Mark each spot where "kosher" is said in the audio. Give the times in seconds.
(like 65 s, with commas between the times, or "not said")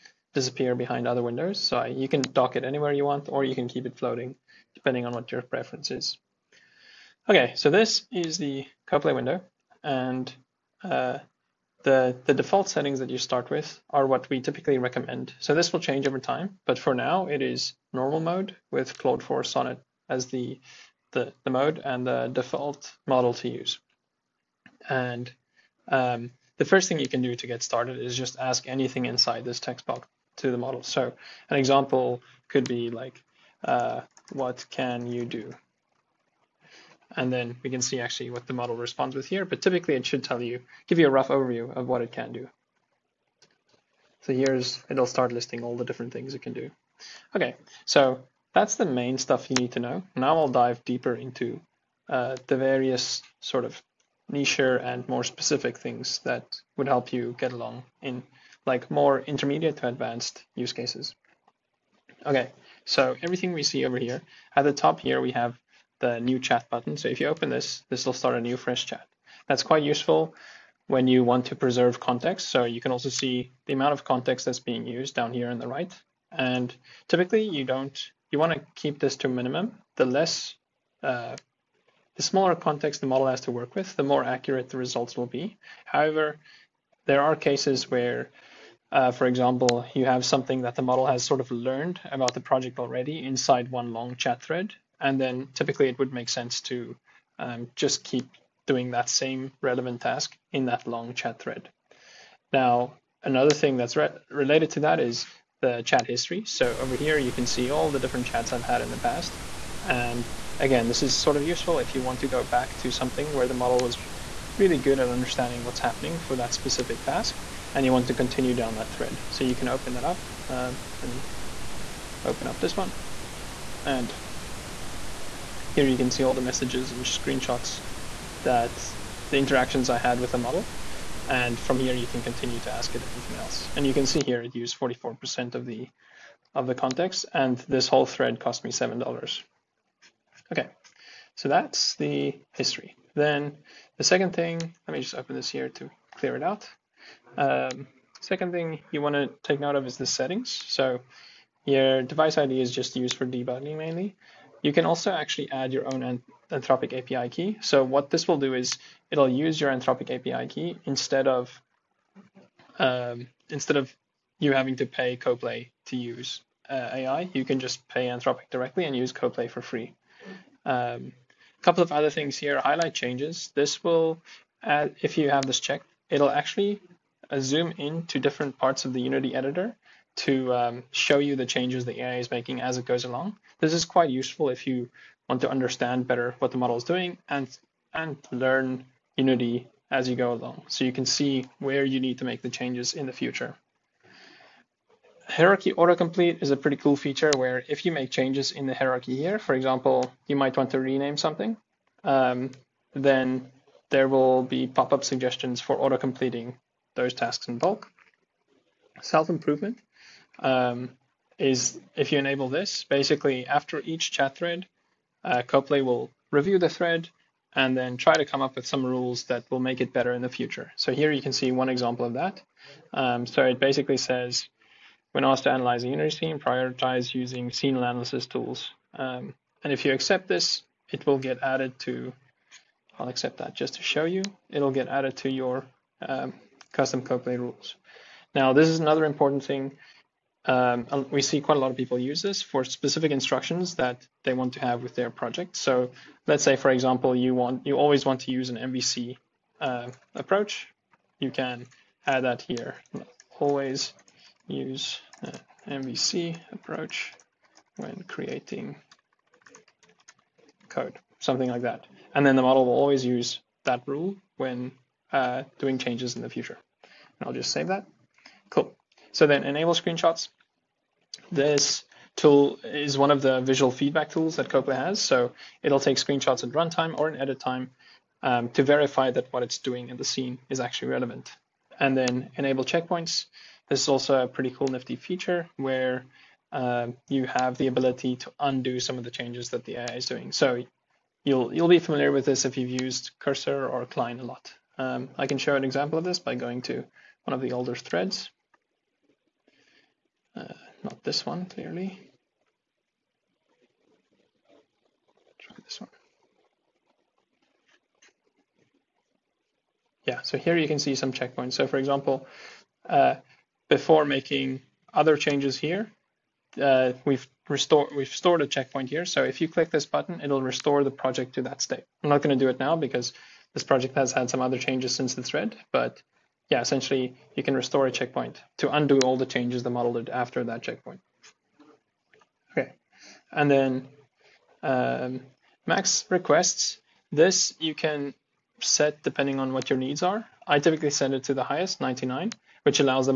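not said.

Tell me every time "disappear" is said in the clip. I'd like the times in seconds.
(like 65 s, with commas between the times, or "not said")
0 s.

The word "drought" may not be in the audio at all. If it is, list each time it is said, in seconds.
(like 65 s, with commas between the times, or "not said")
not said.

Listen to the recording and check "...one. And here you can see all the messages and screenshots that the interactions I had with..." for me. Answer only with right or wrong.
right.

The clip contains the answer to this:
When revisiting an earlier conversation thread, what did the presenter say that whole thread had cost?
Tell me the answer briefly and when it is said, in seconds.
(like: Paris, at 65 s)
$7, at 138 s.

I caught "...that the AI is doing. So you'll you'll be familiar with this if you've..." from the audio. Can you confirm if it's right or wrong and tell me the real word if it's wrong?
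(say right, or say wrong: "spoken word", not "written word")
right.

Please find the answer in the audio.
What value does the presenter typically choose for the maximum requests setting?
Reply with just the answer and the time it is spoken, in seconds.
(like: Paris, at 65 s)
99, at 341 s.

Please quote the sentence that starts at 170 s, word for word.
A um, couple of other things here, highlight changes.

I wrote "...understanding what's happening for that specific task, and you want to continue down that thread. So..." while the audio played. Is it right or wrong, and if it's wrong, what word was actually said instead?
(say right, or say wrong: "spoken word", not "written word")
right.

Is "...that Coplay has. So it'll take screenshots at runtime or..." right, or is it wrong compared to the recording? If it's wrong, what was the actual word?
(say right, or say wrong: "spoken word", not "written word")
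right.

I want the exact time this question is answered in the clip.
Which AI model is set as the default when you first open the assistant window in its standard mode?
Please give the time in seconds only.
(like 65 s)
18 s.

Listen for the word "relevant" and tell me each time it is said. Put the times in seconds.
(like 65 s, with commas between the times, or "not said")
99 s, 280 s.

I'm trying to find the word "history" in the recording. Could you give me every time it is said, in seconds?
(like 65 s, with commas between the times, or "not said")
106 s, 142 s.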